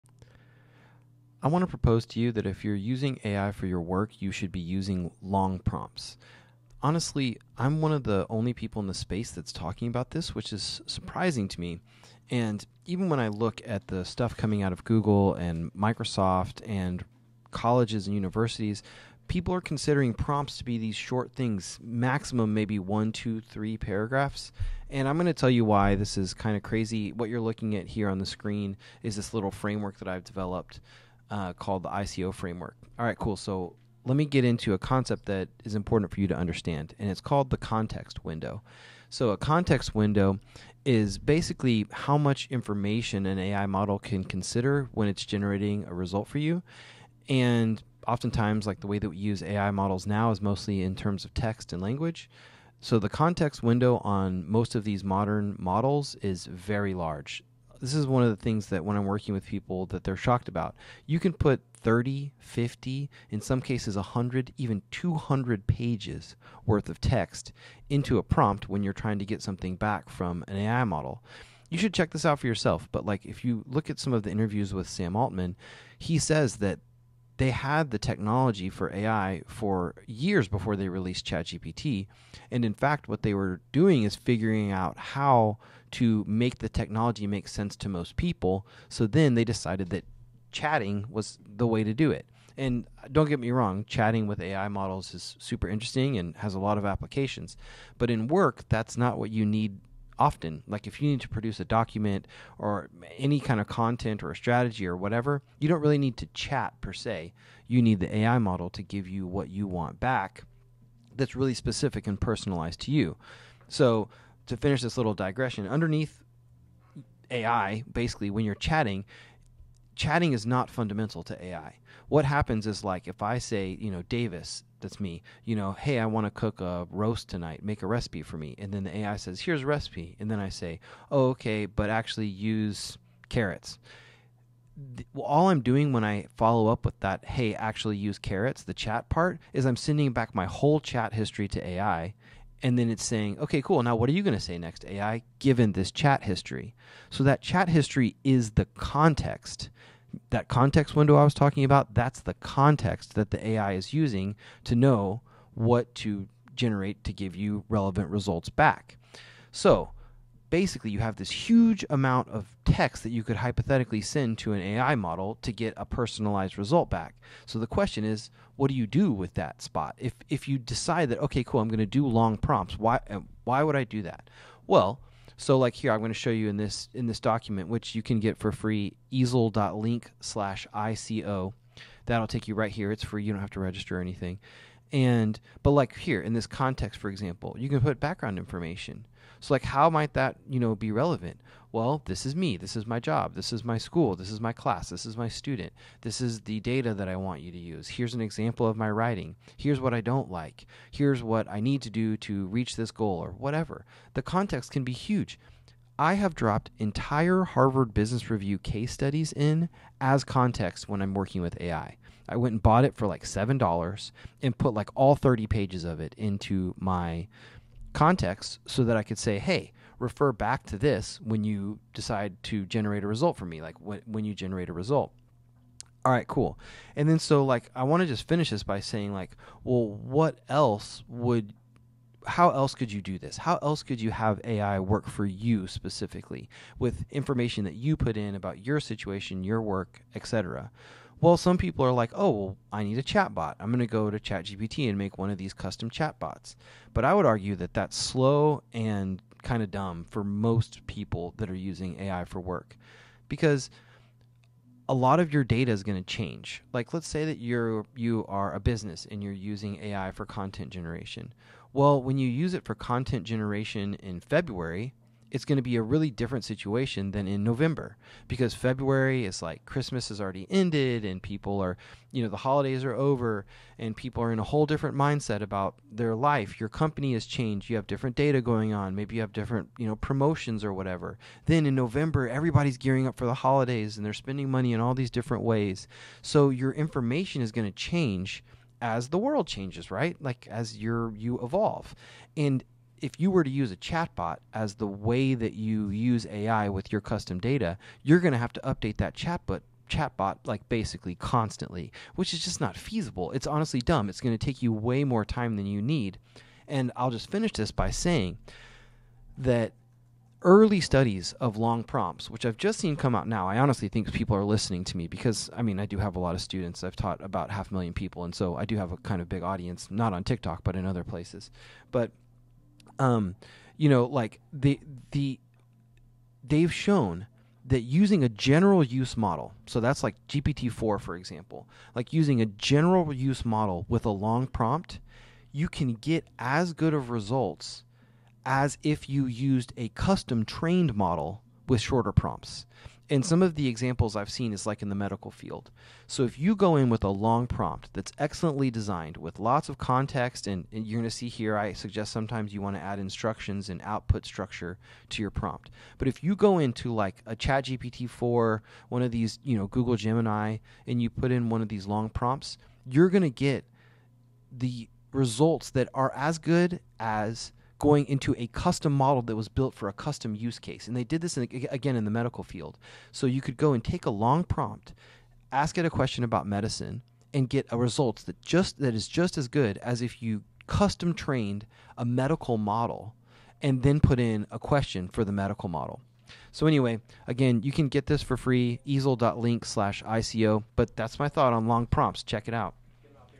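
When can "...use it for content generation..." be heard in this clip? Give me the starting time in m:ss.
4:22.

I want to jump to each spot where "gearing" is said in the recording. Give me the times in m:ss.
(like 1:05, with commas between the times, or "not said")
4:42.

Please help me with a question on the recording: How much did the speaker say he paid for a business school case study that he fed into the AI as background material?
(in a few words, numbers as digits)
$7.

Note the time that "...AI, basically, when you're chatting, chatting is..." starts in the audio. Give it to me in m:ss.
1:57.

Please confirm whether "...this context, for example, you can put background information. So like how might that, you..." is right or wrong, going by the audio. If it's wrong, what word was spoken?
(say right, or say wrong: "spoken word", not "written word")
right.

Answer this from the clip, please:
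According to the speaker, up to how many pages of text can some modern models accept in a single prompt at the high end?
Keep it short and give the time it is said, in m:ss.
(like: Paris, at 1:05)
200, at 1:04.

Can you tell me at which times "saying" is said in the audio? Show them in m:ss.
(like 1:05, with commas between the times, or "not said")
2:23, 3:48, 5:07.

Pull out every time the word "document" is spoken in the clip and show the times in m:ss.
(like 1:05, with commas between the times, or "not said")
1:41, 2:57.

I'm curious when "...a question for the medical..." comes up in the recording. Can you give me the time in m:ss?
6:24.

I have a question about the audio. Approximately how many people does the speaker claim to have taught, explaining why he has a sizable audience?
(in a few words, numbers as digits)
half a million.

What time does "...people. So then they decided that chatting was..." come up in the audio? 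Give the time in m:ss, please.
1:28.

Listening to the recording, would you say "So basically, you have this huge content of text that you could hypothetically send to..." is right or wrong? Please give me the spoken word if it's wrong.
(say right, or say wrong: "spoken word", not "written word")
wrong: "amount", not "content".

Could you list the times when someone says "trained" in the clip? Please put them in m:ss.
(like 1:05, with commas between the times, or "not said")
5:40, 6:21.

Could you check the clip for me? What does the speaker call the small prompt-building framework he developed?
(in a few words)
ICO framework.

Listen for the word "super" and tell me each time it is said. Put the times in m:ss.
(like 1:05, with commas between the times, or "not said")
1:35.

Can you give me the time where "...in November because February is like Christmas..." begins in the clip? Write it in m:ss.
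4:27.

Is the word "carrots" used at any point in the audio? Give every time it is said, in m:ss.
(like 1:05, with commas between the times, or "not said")
2:13, 2:18.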